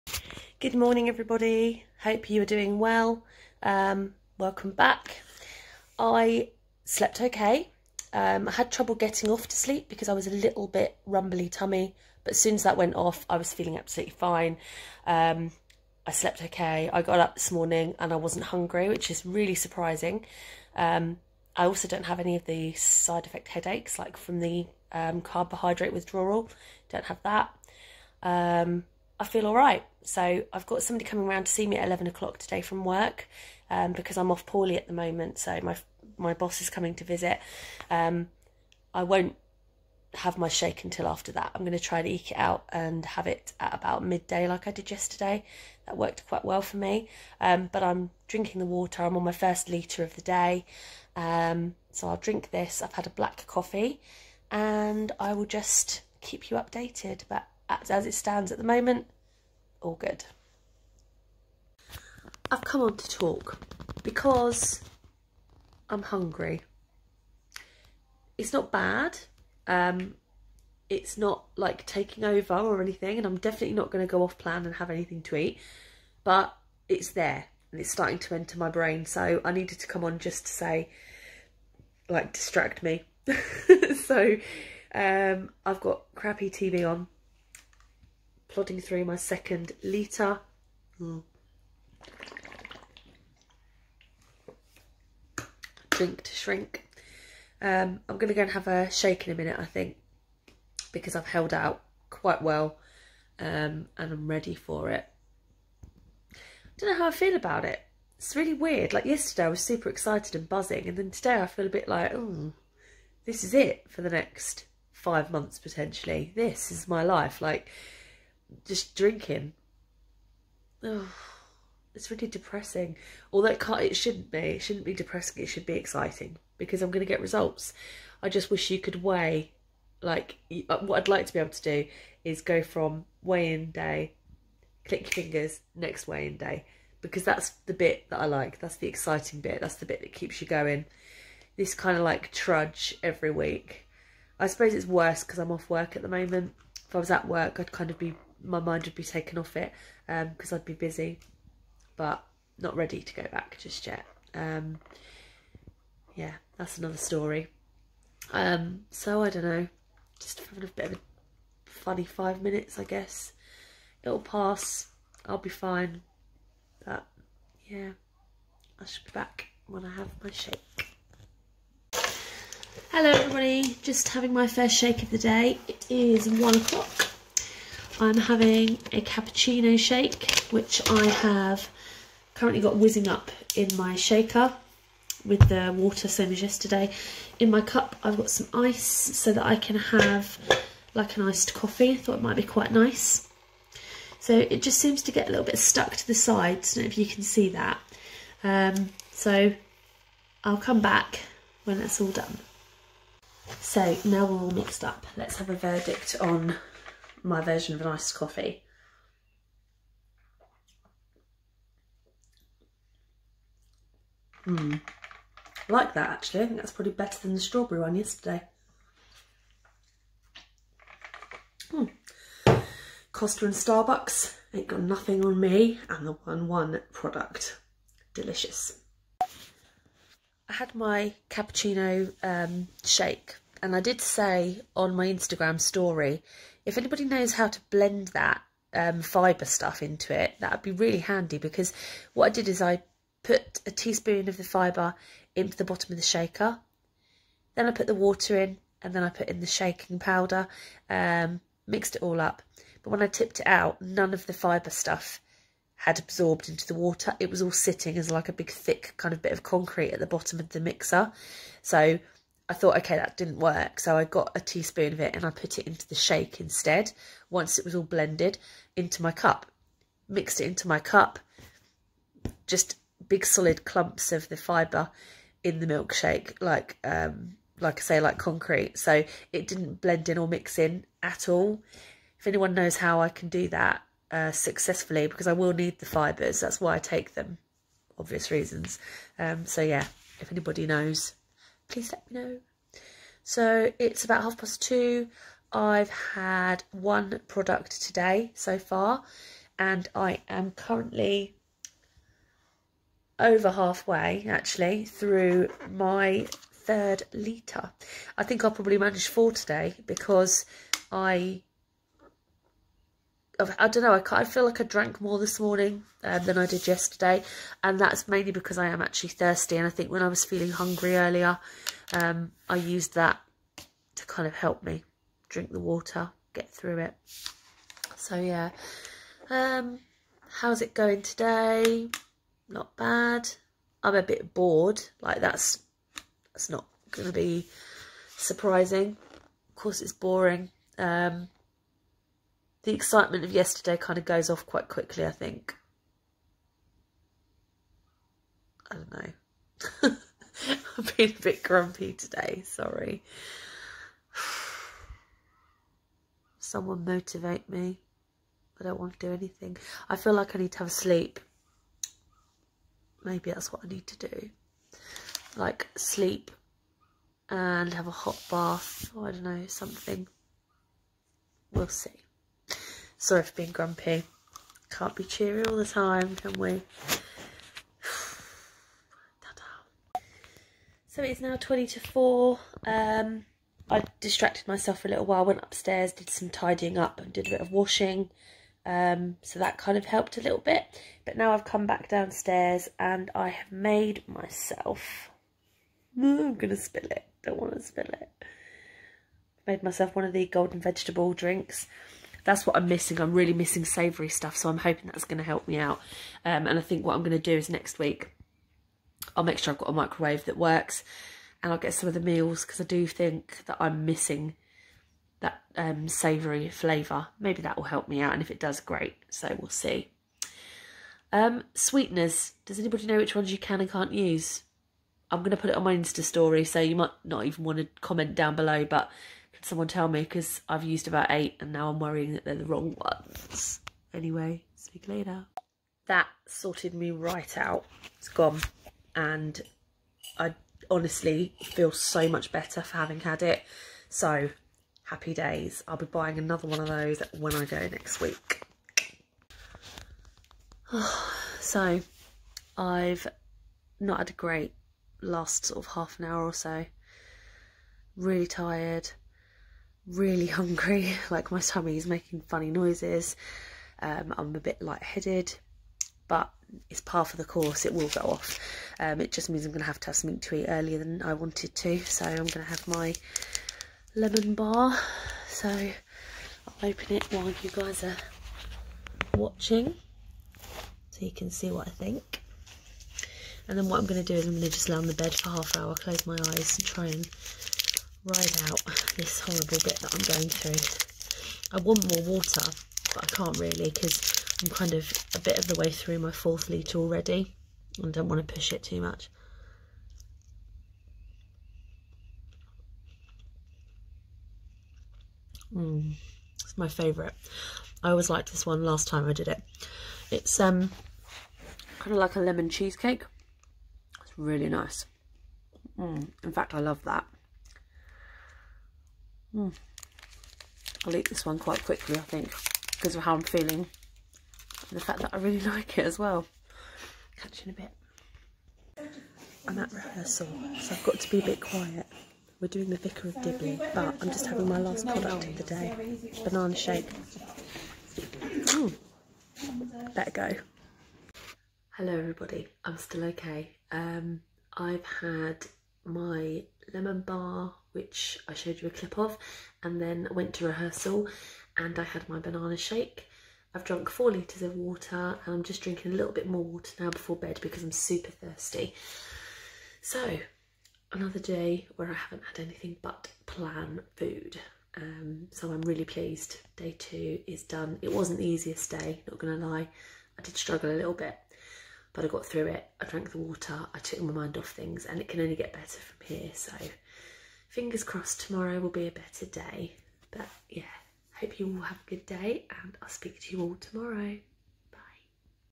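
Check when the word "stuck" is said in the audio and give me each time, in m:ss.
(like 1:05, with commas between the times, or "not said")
3:15.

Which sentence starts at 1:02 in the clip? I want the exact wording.
I've come on to talk because I'm hungry.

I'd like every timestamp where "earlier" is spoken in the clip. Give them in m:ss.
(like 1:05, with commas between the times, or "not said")
5:20, 7:50.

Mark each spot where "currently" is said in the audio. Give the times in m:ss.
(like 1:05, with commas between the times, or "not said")
3:02, 5:00.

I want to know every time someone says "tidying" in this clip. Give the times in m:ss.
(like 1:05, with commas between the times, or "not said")
6:26.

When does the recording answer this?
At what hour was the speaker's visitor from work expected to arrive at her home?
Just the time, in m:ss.
0:31.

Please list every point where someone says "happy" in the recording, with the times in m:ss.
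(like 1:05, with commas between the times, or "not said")
7:24.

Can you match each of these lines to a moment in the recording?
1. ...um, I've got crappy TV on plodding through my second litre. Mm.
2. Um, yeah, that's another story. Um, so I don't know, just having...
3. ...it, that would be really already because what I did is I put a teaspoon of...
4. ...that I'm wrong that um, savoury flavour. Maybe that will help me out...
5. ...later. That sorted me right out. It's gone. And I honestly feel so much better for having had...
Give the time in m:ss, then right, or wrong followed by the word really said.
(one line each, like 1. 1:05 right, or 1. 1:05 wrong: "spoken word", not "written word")
1. 1:24 right
2. 2:34 right
3. 4:00 wrong: "handy", not "already"
4. 6:53 wrong: "missing", not "wrong"
5. 7:14 right.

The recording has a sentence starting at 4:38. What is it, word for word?
So it didn't blend in or mix in at all.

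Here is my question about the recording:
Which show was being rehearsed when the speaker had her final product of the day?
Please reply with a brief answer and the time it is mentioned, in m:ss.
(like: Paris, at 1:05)
The Vicar of Dibley, at 8:52.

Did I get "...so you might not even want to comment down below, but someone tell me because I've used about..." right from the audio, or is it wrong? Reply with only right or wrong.
right.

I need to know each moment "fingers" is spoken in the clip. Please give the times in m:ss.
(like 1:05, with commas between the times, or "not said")
2:15, 9:37.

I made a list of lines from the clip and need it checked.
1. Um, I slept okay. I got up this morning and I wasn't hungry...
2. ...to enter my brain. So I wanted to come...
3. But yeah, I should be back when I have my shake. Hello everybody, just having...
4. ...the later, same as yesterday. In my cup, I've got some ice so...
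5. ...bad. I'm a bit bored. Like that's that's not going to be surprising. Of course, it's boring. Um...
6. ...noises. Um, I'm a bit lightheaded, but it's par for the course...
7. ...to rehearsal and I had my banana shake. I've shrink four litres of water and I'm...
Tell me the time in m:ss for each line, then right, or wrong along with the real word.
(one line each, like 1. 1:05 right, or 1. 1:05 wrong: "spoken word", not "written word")
1. 0:15 right
2. 1:18 wrong: "needed", not "wanted"
3. 2:46 right
4. 3:05 wrong: "water", not "later"
5. 5:32 right
6. 7:42 right
7. 9:10 wrong: "drunk", not "shrink".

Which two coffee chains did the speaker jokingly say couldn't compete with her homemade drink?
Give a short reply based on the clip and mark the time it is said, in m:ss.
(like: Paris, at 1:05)
Costa and Starbucks, at 3:43.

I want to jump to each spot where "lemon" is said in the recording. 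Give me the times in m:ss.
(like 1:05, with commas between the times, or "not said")
7:53, 8:32, 9:06.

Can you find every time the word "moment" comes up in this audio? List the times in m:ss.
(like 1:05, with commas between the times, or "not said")
0:34, 0:58, 2:26.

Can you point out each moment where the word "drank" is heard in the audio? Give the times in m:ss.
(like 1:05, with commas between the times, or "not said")
5:14, 9:32.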